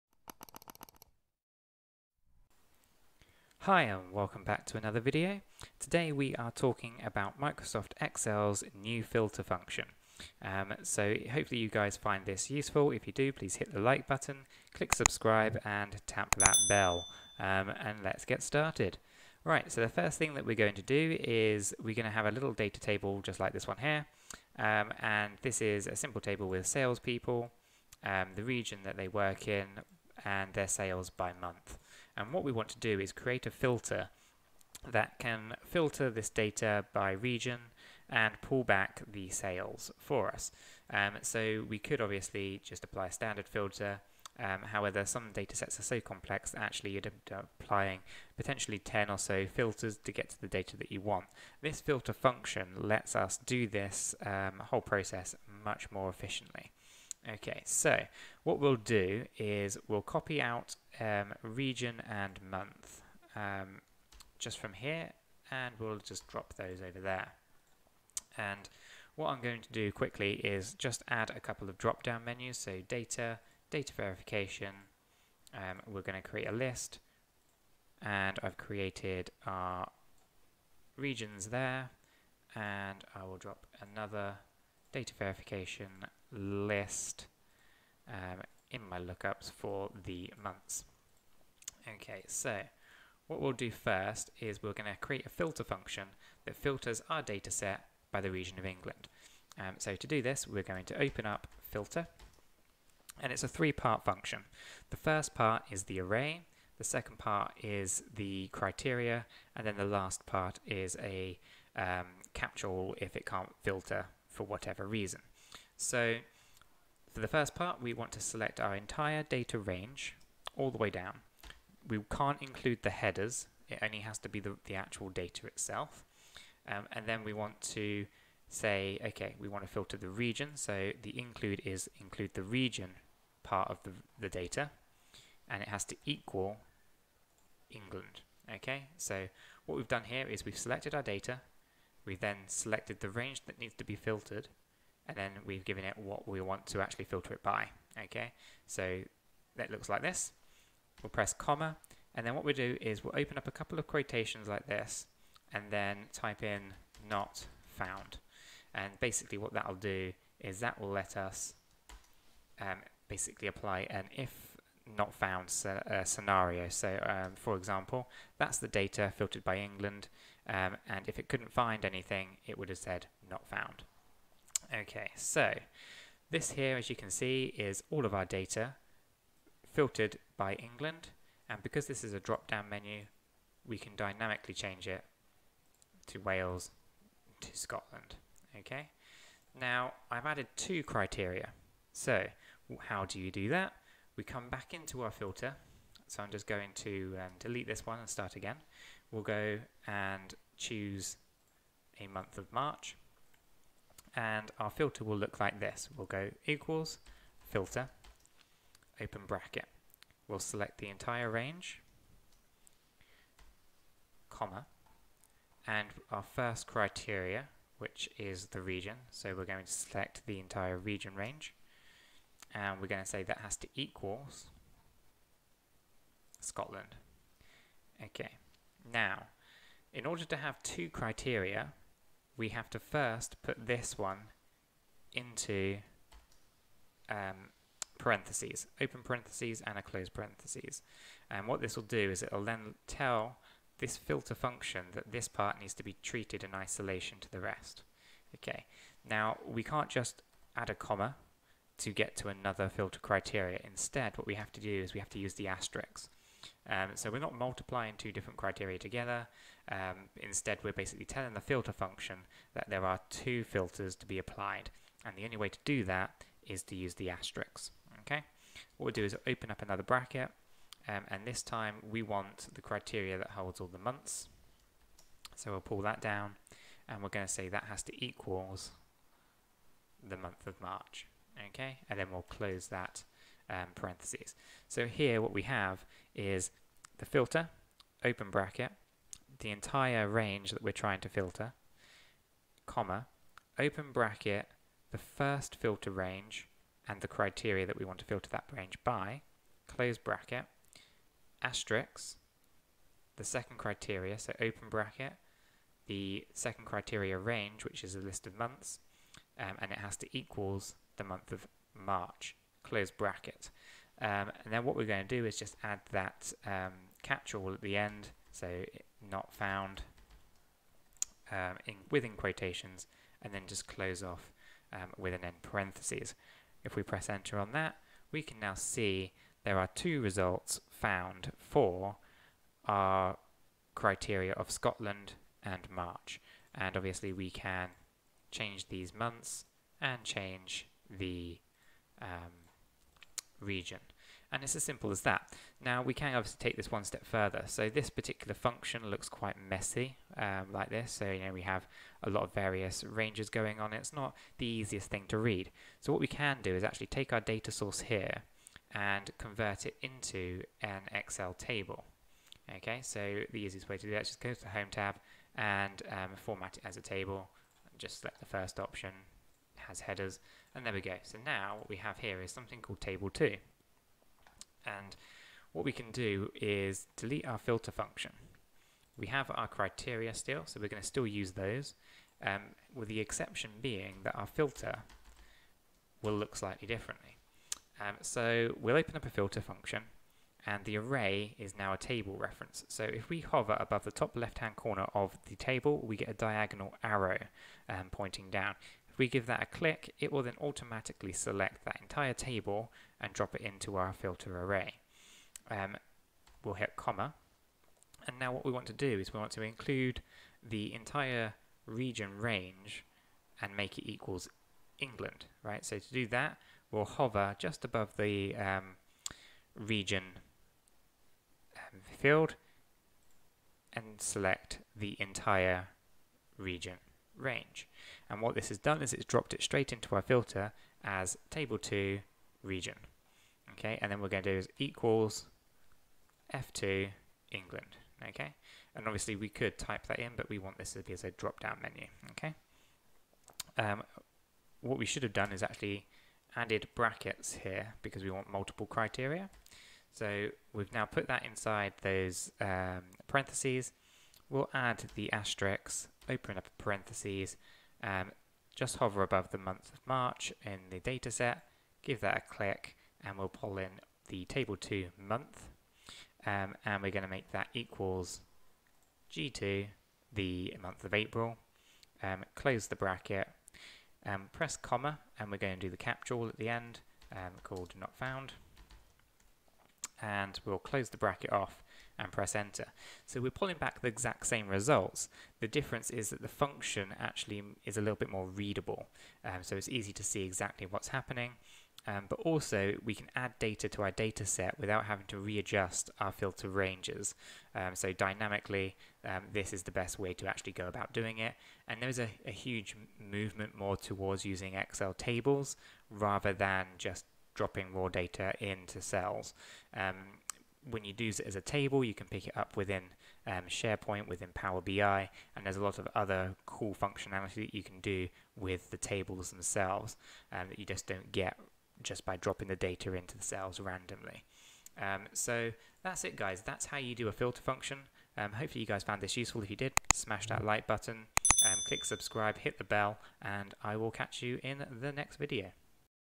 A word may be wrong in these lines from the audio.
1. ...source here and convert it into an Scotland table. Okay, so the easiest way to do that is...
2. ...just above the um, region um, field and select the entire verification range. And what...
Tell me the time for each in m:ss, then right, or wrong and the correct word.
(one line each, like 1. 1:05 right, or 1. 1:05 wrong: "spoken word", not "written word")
1. 5:57 wrong: "Excel", not "Scotland"
2. 6:57 wrong: "region", not "verification".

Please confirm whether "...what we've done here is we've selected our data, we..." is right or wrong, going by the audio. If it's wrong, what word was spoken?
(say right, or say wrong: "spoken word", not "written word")
right.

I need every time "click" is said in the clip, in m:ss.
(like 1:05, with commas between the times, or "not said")
0:14, 6:39, 7:42, 8:51.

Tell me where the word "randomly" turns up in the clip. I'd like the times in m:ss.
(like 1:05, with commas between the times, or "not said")
8:43.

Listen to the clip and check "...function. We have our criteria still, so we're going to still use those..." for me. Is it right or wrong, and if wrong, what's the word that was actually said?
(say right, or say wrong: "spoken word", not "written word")
right.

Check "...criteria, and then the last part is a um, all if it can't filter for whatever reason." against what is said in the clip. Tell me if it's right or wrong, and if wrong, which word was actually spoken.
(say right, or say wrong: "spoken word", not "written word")
right.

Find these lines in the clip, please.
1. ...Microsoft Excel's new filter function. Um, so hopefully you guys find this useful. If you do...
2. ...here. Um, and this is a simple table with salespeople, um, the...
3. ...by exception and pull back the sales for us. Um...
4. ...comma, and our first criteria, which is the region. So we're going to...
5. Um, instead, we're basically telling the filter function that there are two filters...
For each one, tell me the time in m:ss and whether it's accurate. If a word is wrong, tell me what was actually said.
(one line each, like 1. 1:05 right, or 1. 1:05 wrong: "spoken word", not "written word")
1. 0:07 right
2. 0:23 right
3. 0:36 wrong: "region", not "exception"
4. 3:34 right
5. 4:19 right.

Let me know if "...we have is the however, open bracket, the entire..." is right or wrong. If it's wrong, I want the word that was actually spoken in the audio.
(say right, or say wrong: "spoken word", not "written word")
wrong: "filter", not "however".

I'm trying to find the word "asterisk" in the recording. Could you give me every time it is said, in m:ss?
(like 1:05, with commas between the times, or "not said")
4:15, 4:27, 5:01, 7:35.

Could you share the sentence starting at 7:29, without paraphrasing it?
So we've now put that inside those um, parentheses.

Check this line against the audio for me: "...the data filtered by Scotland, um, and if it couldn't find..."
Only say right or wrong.
wrong.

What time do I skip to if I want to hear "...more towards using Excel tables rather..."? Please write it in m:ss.
8:23.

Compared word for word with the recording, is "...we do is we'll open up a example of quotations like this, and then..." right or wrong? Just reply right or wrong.
wrong.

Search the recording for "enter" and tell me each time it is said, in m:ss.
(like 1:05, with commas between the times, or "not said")
5:27, 8:02.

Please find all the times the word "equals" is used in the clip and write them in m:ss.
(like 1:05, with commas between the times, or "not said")
2:16, 3:26, 3:43, 4:38, 5:10, 6:53, 7:14, 7:47.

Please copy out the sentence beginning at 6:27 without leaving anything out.
Um, so we'll open up a filter function, and the array is now a table reference.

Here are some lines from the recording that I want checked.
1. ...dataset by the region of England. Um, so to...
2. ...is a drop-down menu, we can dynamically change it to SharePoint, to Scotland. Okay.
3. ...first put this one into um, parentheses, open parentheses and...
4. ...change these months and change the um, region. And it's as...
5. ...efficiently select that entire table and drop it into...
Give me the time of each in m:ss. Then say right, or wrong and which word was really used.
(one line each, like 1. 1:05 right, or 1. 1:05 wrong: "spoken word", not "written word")
1. 1:37 right
2. 3:02 wrong: "Wales", not "SharePoint"
3. 3:52 right
4. 5:38 right
5. 6:40 wrong: "automatically", not "efficiently".